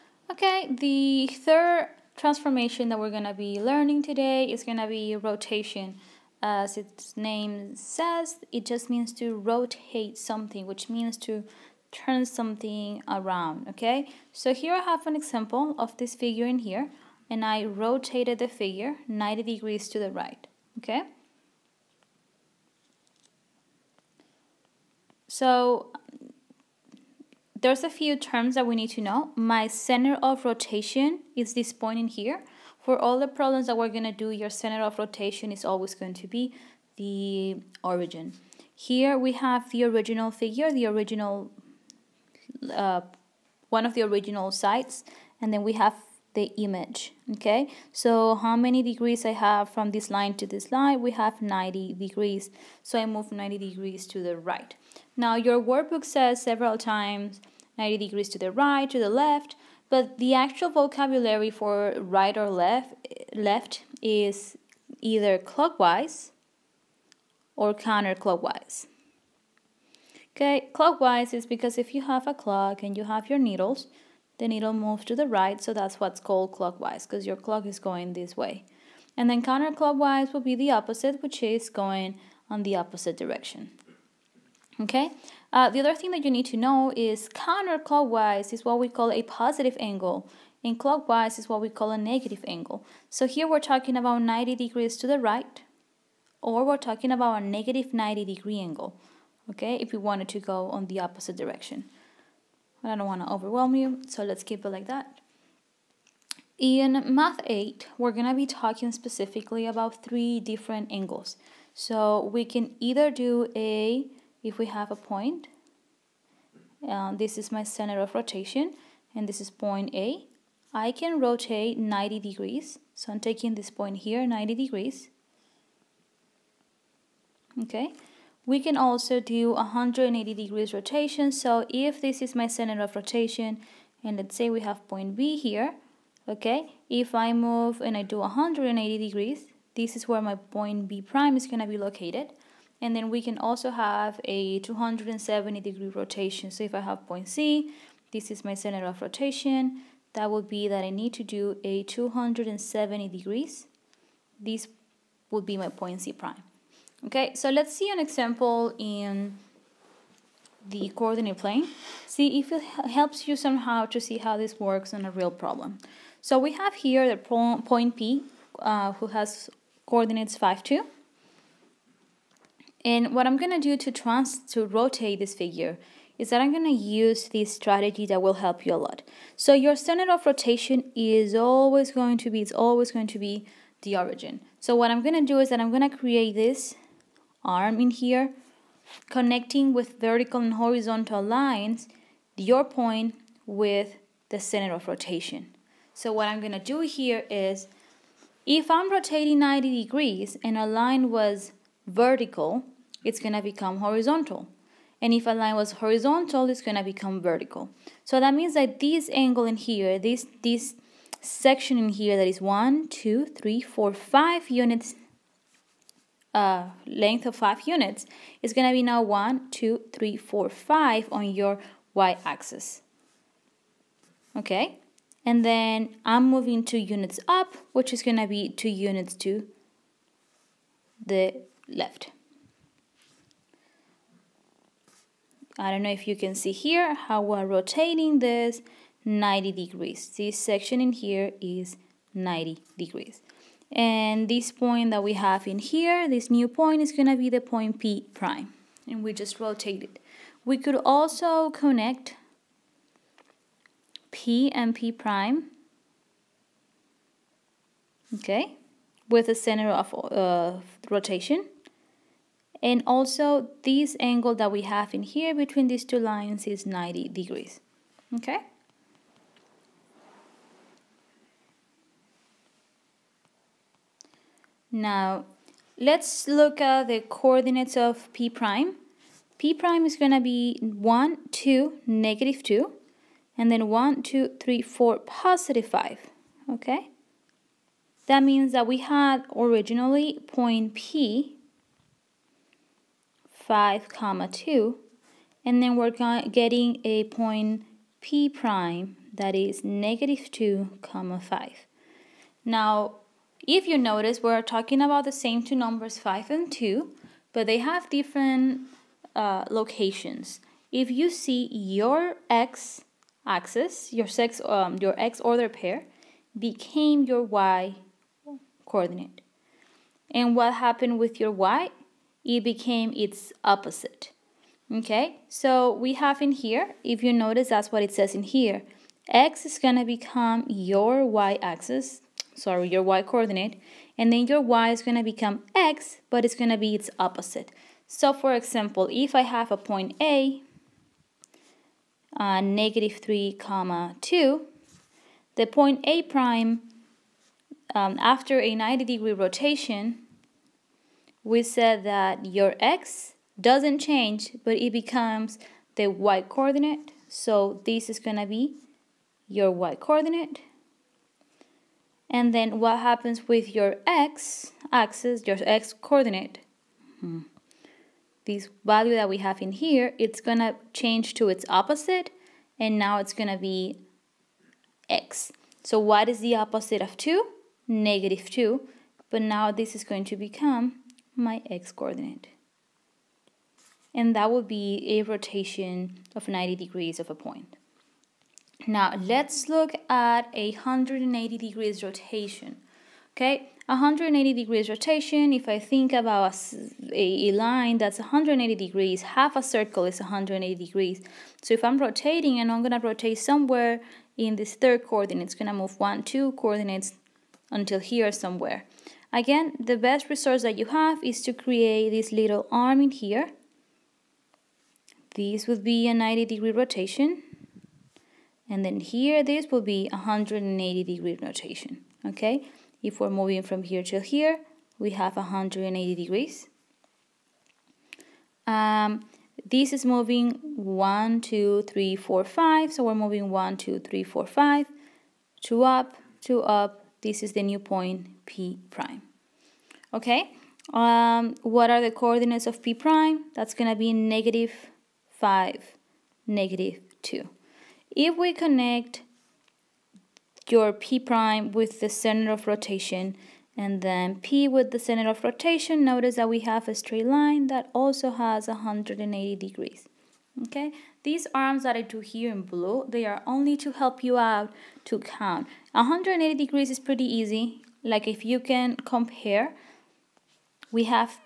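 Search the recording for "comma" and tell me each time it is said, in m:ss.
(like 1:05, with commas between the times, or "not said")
4:53, 5:00, 5:43.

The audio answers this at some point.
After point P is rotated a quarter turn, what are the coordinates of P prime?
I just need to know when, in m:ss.
4:59.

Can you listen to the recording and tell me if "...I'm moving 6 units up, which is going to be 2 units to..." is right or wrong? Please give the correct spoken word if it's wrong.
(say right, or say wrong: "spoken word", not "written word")
wrong: "2", not "6".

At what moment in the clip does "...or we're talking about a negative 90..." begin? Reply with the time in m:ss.
1:36.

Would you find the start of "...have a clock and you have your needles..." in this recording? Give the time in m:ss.
1:12.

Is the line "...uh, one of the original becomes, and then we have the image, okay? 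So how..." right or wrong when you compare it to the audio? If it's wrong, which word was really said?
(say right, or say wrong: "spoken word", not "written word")
wrong: "sides", not "becomes".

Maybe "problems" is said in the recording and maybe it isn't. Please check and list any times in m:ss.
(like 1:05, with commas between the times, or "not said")
0:33, 2:45.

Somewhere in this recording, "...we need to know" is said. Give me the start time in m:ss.
0:28.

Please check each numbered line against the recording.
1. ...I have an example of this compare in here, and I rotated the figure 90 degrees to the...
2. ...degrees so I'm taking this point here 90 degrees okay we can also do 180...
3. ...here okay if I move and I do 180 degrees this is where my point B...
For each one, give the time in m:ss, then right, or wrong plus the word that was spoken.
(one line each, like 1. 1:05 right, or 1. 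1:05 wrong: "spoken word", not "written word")
1. 0:14 wrong: "figure", not "compare"
2. 2:02 right
3. 2:15 right.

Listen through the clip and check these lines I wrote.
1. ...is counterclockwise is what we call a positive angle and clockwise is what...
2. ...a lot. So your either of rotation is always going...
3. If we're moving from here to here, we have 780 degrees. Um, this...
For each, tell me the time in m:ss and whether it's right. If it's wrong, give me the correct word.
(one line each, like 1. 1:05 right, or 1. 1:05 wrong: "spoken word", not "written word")
1. 1:26 right
2. 2:58 wrong: "center", not "either"
3. 7:02 wrong: "180", not "780".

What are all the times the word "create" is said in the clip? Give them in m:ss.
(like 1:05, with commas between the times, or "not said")
3:05, 6:51.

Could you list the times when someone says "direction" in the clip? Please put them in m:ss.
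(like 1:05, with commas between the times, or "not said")
1:23, 1:41.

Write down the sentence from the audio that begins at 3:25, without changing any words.
And if a line was horizontal, it's going to become vertical.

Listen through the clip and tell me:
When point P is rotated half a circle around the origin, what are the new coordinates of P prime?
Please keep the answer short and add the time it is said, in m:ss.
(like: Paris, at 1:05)
(-5, -2), at 7:23.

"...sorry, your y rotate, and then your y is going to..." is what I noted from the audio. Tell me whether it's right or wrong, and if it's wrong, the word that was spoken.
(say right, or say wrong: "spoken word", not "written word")
wrong: "coordinate", not "rotate".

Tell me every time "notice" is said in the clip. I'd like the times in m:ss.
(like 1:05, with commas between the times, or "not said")
5:03, 5:27, 7:35.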